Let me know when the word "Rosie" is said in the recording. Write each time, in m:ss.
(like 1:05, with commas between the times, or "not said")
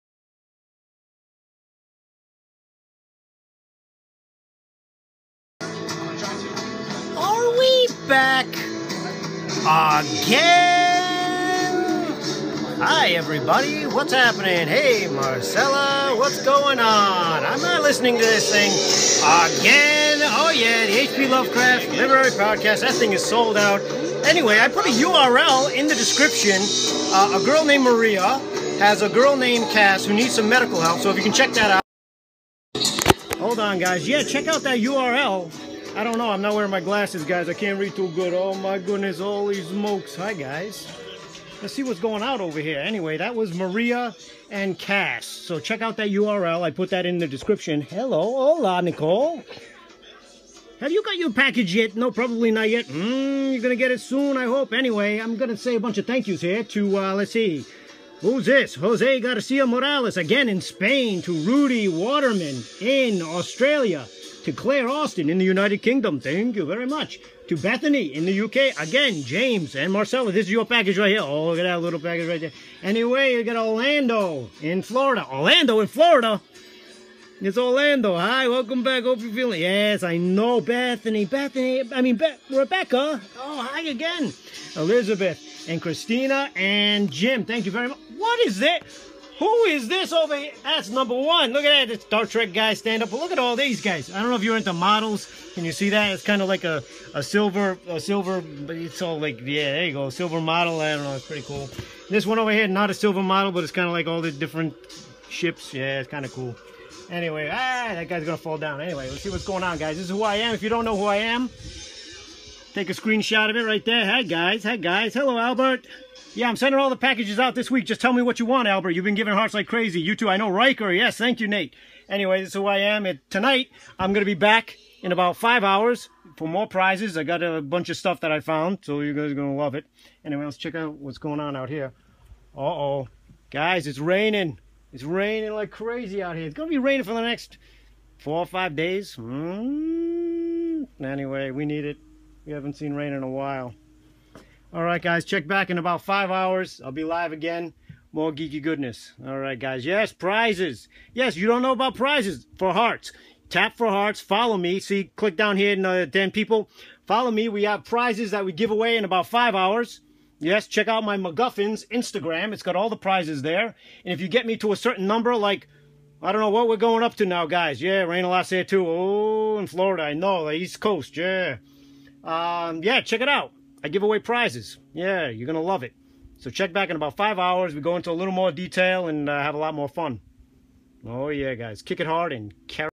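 not said.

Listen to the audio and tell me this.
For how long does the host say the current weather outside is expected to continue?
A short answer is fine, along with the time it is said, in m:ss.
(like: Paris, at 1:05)
4 or 5 days, at 2:18.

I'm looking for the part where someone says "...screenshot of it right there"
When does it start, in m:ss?
1:52.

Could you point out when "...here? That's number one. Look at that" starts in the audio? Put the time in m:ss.
1:30.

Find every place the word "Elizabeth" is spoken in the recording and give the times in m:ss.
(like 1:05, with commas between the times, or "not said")
1:24.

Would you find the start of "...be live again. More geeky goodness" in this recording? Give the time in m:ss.
2:26.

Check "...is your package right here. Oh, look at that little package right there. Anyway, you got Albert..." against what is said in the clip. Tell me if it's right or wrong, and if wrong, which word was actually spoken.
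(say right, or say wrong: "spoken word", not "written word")
wrong: "Orlando", not "Albert".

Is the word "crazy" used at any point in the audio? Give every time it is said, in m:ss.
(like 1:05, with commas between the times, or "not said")
1:59, 2:15.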